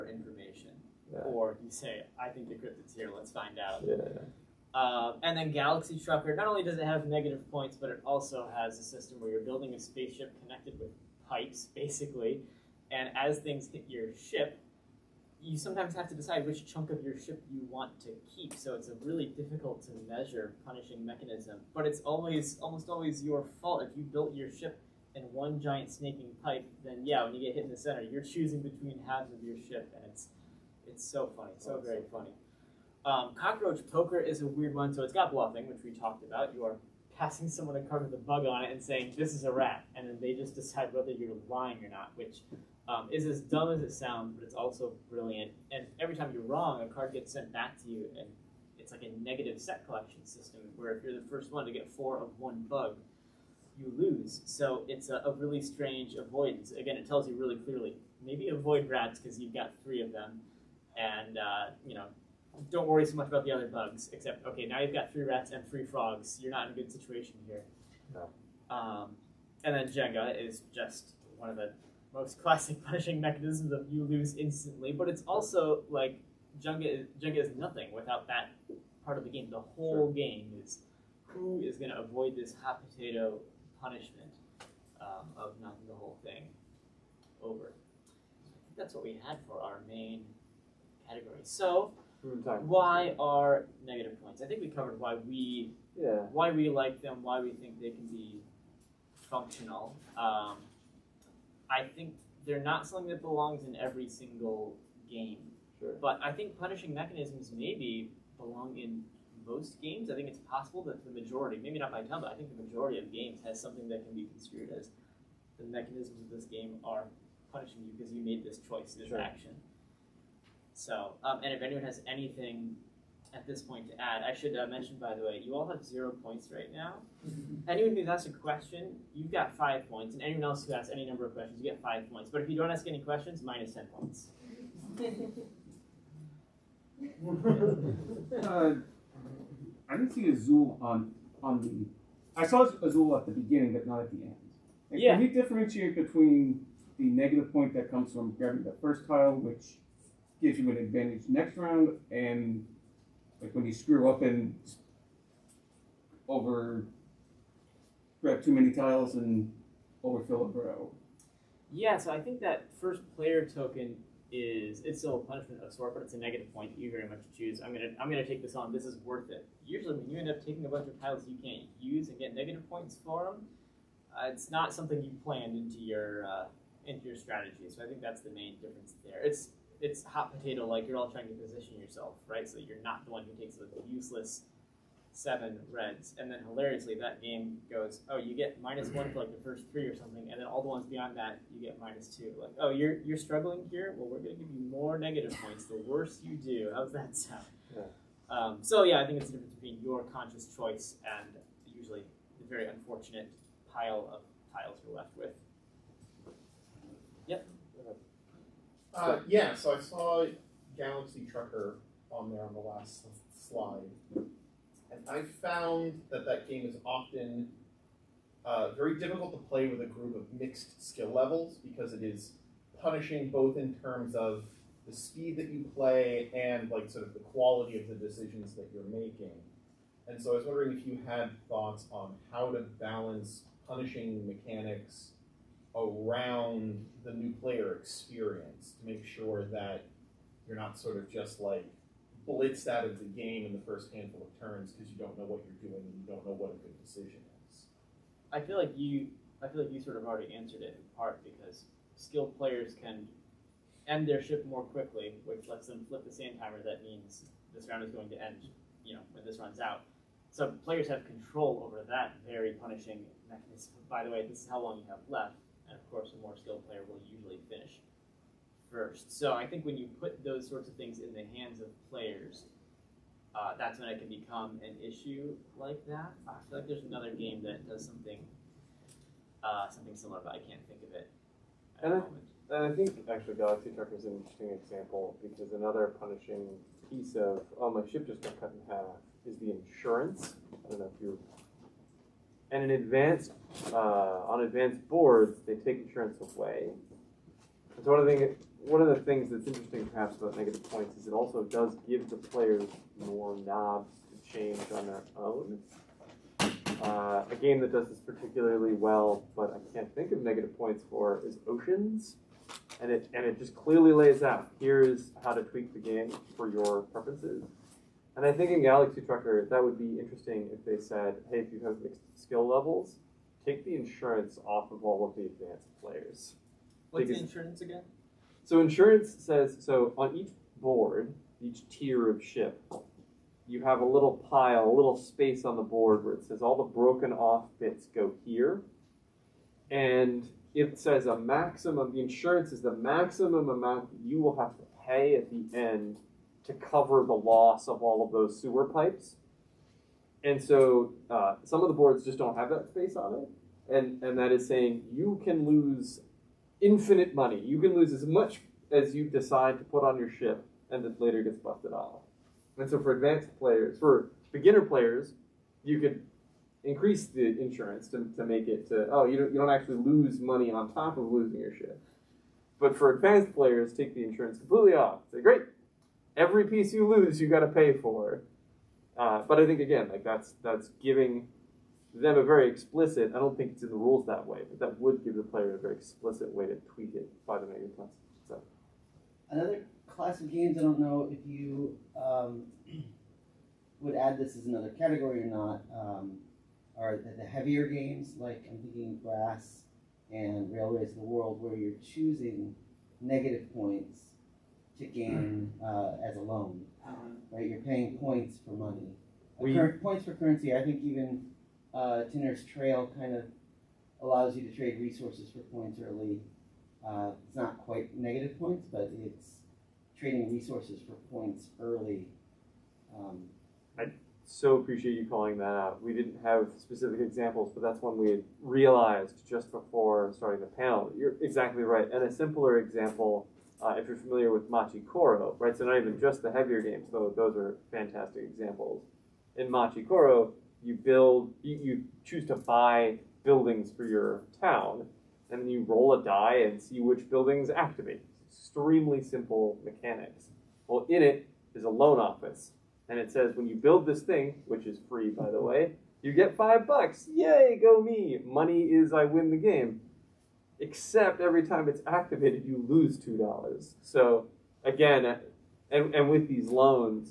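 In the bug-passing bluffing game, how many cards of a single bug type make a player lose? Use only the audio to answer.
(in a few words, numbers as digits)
4.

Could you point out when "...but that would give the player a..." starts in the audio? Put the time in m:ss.
6:24.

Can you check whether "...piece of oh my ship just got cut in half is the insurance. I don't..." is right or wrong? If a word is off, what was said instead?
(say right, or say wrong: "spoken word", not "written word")
right.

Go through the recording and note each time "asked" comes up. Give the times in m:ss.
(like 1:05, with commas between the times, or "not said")
2:08.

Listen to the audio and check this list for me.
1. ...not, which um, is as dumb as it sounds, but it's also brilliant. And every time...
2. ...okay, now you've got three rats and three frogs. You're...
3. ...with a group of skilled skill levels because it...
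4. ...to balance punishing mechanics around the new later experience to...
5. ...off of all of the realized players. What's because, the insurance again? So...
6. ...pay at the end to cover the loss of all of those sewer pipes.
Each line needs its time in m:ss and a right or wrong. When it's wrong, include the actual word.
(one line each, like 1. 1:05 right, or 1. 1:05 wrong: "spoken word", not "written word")
1. 0:41 right
2. 1:04 right
3. 3:39 wrong: "mixed", not "skilled"
4. 3:52 wrong: "player", not "later"
5. 5:24 wrong: "advanced", not "realized"
6. 5:44 right.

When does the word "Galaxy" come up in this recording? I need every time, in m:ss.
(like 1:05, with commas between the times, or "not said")
0:05, 3:30, 4:43, 5:18.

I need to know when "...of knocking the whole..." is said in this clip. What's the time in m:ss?
1:25.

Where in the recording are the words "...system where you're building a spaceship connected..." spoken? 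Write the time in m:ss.
0:08.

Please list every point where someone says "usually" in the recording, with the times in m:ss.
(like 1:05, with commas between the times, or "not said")
2:49, 3:21, 4:27.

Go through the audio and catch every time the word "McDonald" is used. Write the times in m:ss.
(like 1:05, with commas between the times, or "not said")
not said.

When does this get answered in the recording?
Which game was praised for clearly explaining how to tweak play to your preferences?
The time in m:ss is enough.
5:11.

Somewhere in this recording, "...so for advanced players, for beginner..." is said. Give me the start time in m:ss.
6:02.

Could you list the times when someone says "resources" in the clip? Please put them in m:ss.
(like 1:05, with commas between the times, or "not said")
6:54, 7:00.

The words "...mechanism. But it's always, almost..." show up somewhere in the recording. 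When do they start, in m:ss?
0:21.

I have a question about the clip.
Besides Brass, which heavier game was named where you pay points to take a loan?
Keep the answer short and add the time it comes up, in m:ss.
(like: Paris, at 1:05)
Railways of the World, at 6:40.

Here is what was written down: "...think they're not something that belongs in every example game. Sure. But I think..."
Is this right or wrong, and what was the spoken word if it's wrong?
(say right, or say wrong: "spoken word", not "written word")
wrong: "single", not "example".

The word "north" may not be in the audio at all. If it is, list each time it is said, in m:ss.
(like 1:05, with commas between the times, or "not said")
not said.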